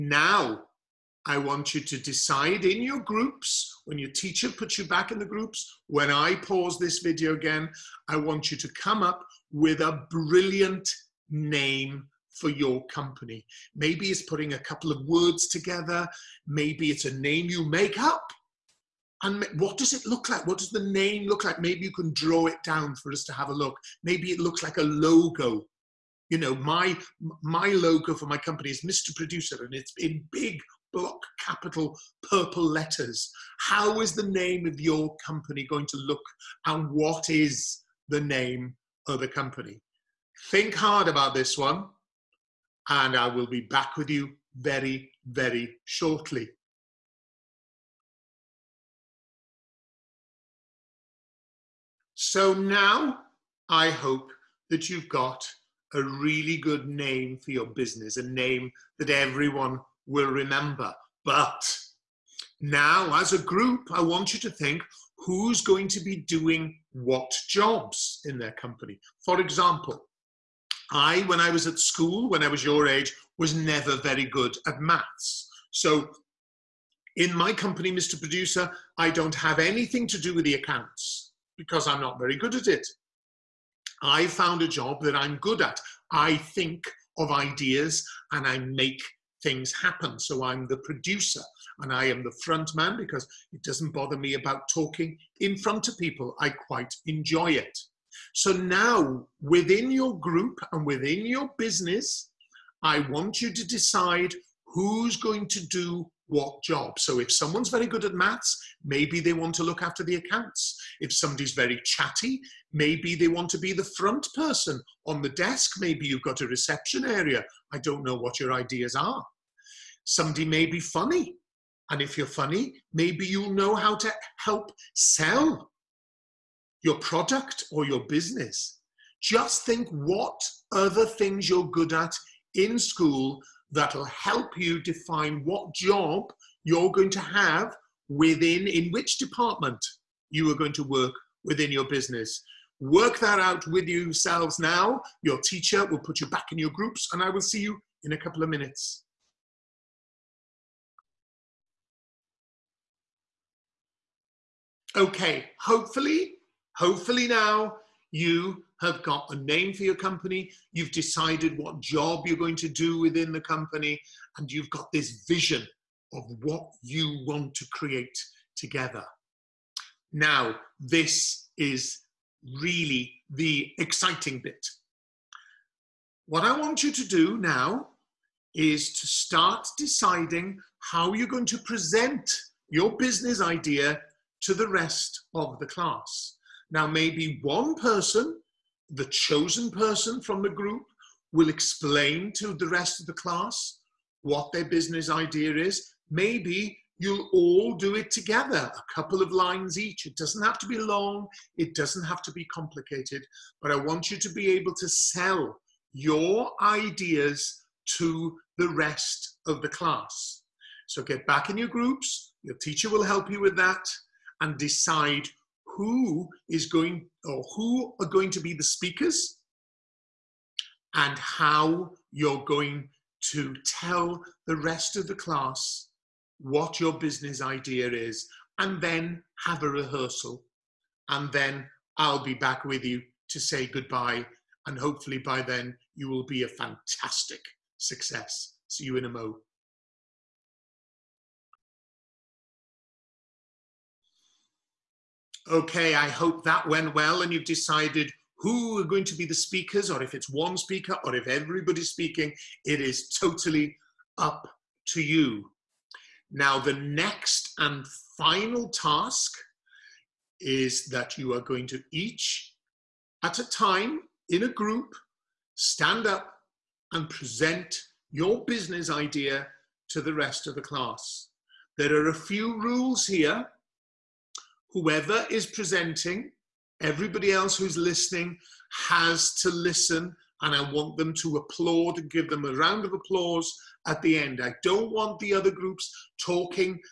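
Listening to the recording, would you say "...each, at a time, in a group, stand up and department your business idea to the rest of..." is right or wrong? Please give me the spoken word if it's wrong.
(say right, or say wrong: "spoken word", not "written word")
wrong: "present", not "department".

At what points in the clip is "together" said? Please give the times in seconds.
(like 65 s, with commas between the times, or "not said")
15 s, 168 s, 198 s.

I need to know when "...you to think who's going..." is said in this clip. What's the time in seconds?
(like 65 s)
64 s.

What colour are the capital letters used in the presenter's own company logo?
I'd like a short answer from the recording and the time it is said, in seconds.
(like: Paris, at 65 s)
Purple, at 32 s.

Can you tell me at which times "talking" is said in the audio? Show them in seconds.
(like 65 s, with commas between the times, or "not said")
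94 s, 286 s.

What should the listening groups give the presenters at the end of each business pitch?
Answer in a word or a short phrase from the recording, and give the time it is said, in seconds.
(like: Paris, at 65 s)
A round of applause, at 282 s.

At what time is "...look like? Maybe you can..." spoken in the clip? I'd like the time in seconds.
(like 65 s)
21 s.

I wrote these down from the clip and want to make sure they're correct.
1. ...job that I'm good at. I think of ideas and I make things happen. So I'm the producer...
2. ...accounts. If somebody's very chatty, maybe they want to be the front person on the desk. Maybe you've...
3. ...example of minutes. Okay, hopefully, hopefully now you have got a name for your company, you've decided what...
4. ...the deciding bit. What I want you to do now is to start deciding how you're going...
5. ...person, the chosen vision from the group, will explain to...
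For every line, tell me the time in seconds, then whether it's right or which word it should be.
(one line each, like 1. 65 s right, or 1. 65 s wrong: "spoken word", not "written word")
1. 84 s right
2. 110 s right
3. 148 s wrong: "couple", not "example"
4. 173 s wrong: "exciting", not "deciding"
5. 187 s wrong: "person", not "vision".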